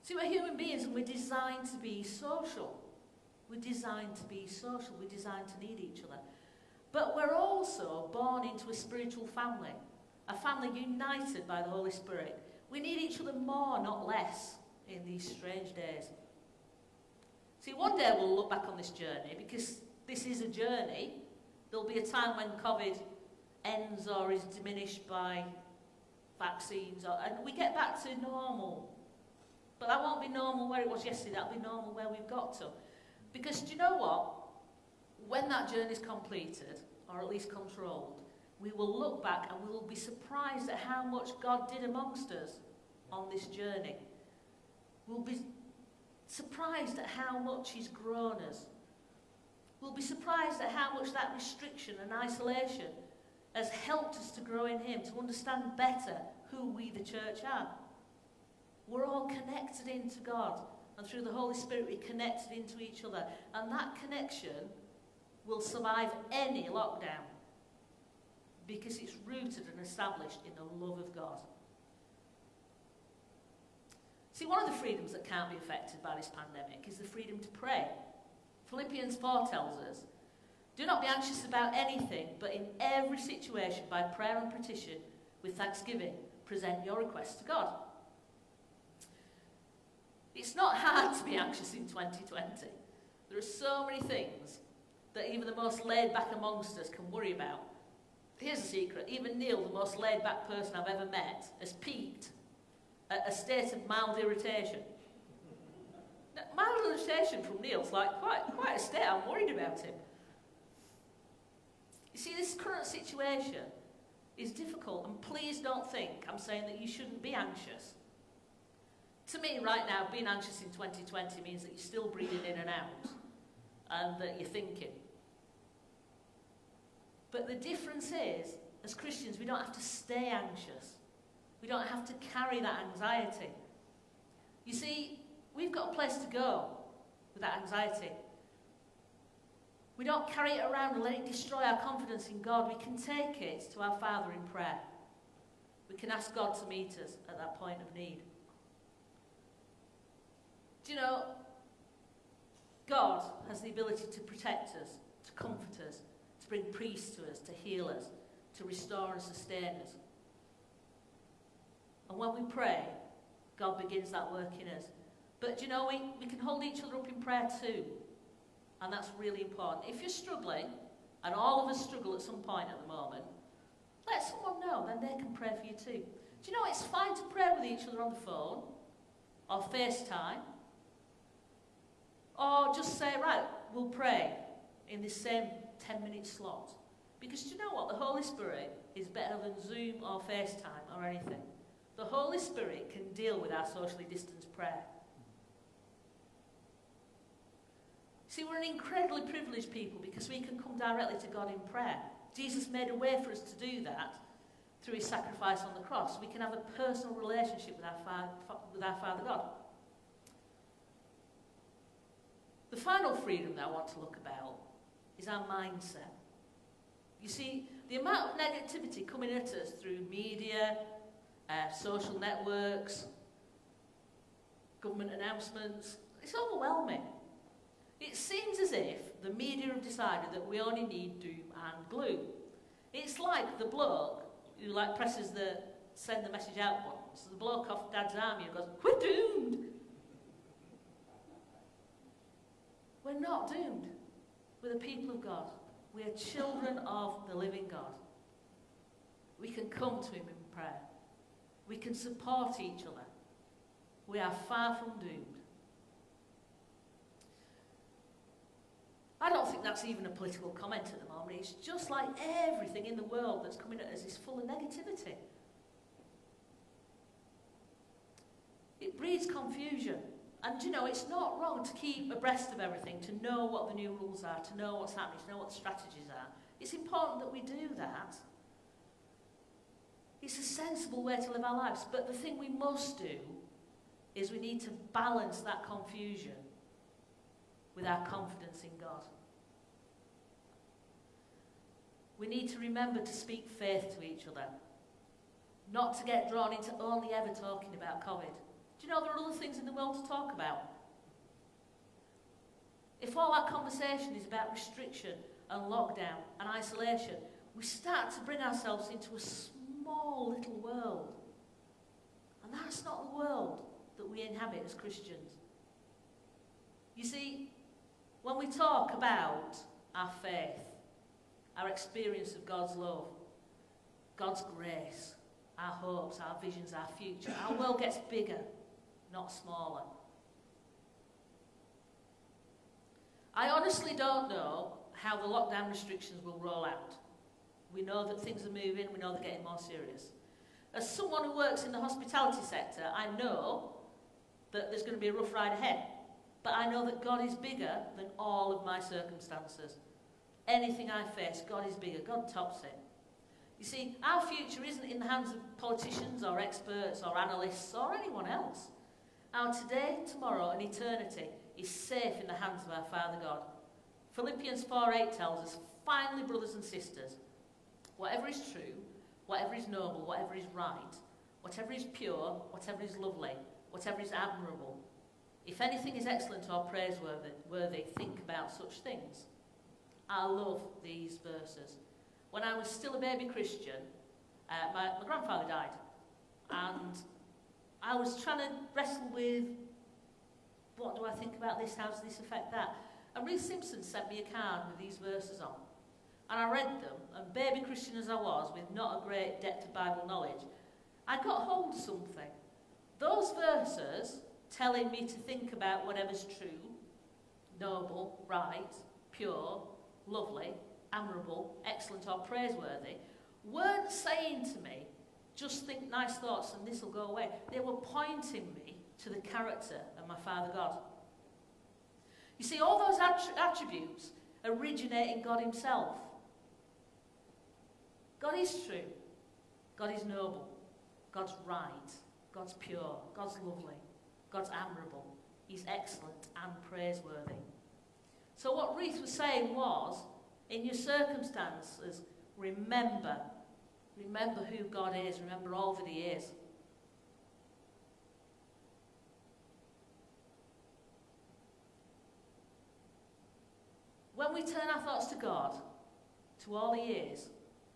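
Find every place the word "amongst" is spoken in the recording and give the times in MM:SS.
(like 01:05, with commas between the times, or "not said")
00:41, 01:36.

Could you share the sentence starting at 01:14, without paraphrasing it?
See, one of the freedoms that can't be affected by this pandemic is the freedom to pray.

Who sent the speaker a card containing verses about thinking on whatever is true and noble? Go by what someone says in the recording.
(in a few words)
Ruth Simpson.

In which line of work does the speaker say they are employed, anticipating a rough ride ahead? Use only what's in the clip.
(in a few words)
Hospitality.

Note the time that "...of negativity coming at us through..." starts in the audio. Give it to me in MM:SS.
03:38.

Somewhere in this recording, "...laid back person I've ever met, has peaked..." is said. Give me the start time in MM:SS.
01:39.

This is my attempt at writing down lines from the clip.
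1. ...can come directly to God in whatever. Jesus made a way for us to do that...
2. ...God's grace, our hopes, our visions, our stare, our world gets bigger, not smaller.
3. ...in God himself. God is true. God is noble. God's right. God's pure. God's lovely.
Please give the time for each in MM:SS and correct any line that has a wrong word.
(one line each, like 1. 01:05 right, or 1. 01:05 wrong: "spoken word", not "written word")
1. 03:20 wrong: "prayer", not "whatever"
2. 05:24 wrong: "future", not "stare"
3. 07:05 right.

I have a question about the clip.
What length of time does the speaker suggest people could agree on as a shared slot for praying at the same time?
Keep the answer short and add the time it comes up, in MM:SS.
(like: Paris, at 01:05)
10 minute, at 03:05.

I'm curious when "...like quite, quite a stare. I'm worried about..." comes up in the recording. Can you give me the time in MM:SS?
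01:47.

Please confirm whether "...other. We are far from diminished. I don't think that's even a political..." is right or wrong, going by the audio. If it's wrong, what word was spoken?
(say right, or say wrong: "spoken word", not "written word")
wrong: "doomed", not "diminished".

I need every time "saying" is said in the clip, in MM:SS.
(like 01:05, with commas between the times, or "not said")
01:56, 06:53, 07:19.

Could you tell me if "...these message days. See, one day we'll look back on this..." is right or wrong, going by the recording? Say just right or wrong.
wrong.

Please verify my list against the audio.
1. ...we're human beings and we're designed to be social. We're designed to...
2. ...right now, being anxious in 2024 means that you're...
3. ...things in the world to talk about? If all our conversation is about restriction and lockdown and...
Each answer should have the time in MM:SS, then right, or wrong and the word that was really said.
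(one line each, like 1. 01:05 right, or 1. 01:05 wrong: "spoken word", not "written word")
1. 00:00 right
2. 01:59 wrong: "2020", not "2024"
3. 04:59 right.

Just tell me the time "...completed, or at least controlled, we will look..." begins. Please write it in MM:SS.
00:35.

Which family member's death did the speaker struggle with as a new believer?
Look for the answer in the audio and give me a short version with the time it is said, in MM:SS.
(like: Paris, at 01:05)
Grandfather, at 06:25.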